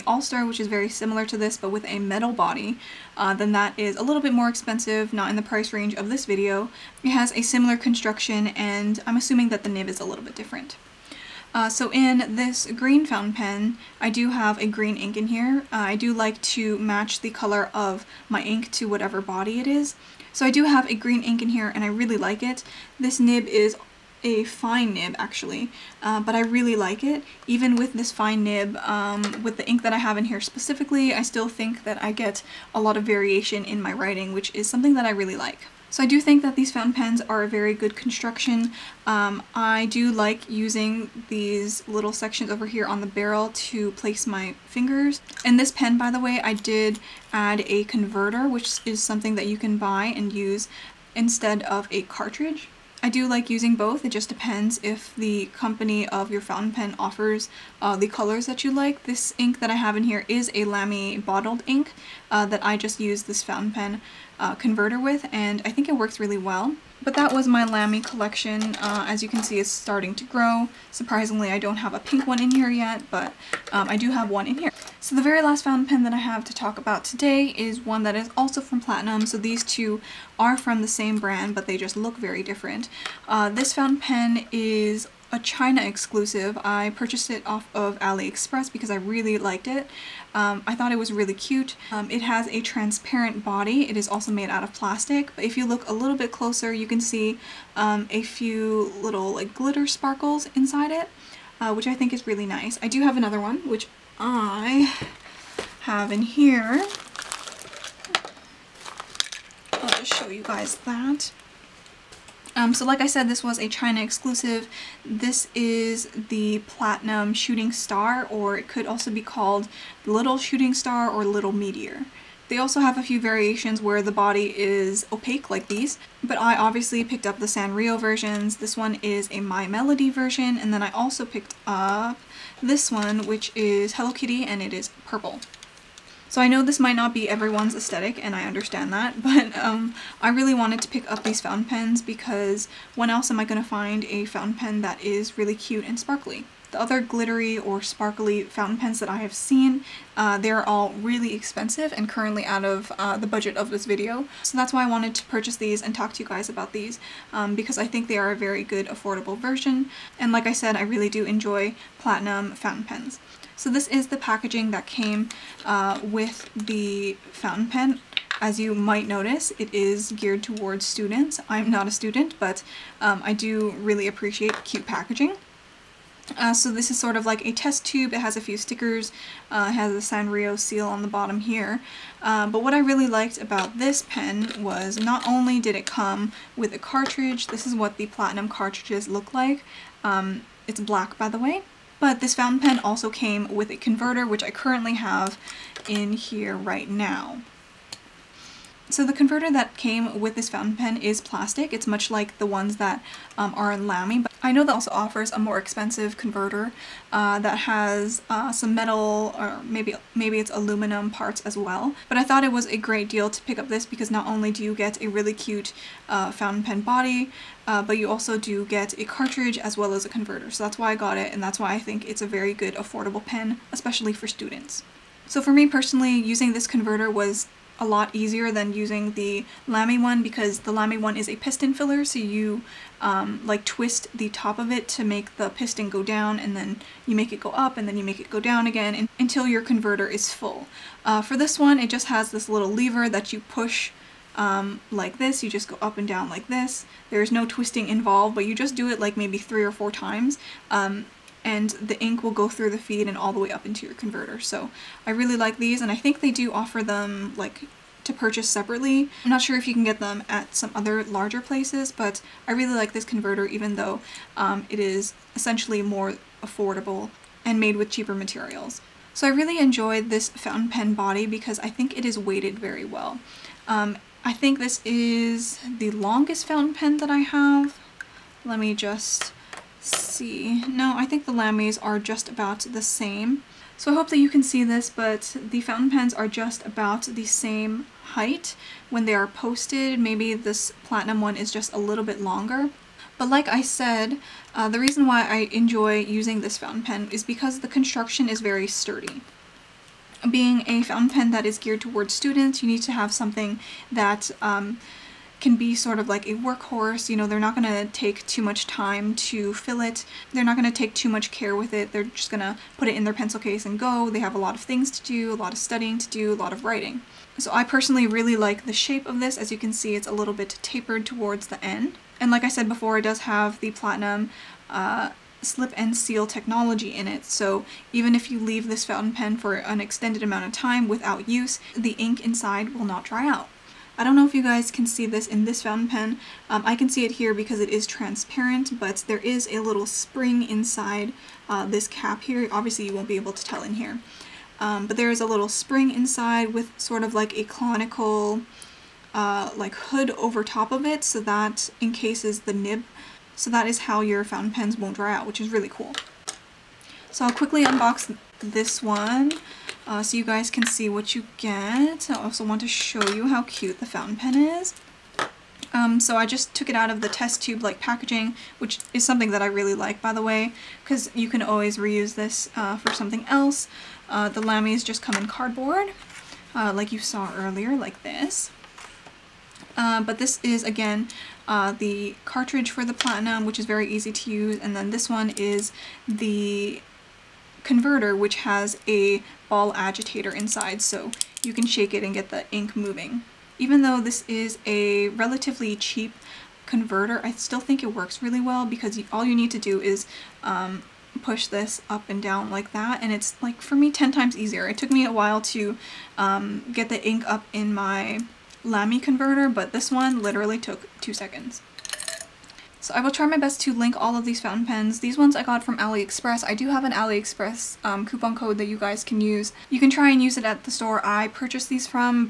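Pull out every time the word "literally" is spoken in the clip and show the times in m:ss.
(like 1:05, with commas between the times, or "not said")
6:50.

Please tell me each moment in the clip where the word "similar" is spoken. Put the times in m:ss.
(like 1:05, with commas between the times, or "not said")
0:00, 0:07.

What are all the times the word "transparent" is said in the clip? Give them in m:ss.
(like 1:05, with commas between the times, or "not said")
1:32, 5:37.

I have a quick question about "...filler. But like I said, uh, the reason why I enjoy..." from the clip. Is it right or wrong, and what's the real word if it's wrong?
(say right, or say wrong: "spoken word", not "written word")
wrong: "longer", not "filler".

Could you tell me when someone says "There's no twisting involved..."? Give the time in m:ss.
4:07.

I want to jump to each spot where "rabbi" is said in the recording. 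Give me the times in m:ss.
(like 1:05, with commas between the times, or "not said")
not said.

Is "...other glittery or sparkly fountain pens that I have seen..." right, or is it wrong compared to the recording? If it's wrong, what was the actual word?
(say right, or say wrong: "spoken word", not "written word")
right.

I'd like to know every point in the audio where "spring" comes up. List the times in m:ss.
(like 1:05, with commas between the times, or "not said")
5:39, 5:45.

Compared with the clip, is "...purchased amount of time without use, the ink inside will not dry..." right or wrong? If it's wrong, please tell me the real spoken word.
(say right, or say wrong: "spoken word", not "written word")
wrong: "extended", not "purchased".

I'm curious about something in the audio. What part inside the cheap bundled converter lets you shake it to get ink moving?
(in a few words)
ball agitator.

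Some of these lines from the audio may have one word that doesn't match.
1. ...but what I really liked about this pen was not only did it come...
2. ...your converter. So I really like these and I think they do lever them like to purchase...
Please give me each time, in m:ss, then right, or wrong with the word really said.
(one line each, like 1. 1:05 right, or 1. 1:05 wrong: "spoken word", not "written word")
1. 3:02 right
2. 4:13 wrong: "offer", not "lever".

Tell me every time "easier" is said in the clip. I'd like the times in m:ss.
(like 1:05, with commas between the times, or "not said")
3:48, 6:44.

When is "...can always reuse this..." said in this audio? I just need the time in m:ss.
6:11.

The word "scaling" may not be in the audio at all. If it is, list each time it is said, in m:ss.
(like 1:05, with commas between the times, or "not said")
not said.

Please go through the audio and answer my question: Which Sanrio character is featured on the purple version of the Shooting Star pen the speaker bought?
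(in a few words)
Hello Kitty.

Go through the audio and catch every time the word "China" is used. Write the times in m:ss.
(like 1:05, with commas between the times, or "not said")
1:25, 1:53.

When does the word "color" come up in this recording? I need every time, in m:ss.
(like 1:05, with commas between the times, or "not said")
0:17, 0:58.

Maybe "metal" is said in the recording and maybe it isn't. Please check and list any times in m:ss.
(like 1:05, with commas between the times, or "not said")
0:01, 3:28.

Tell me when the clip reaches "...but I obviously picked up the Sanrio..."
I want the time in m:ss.
2:06.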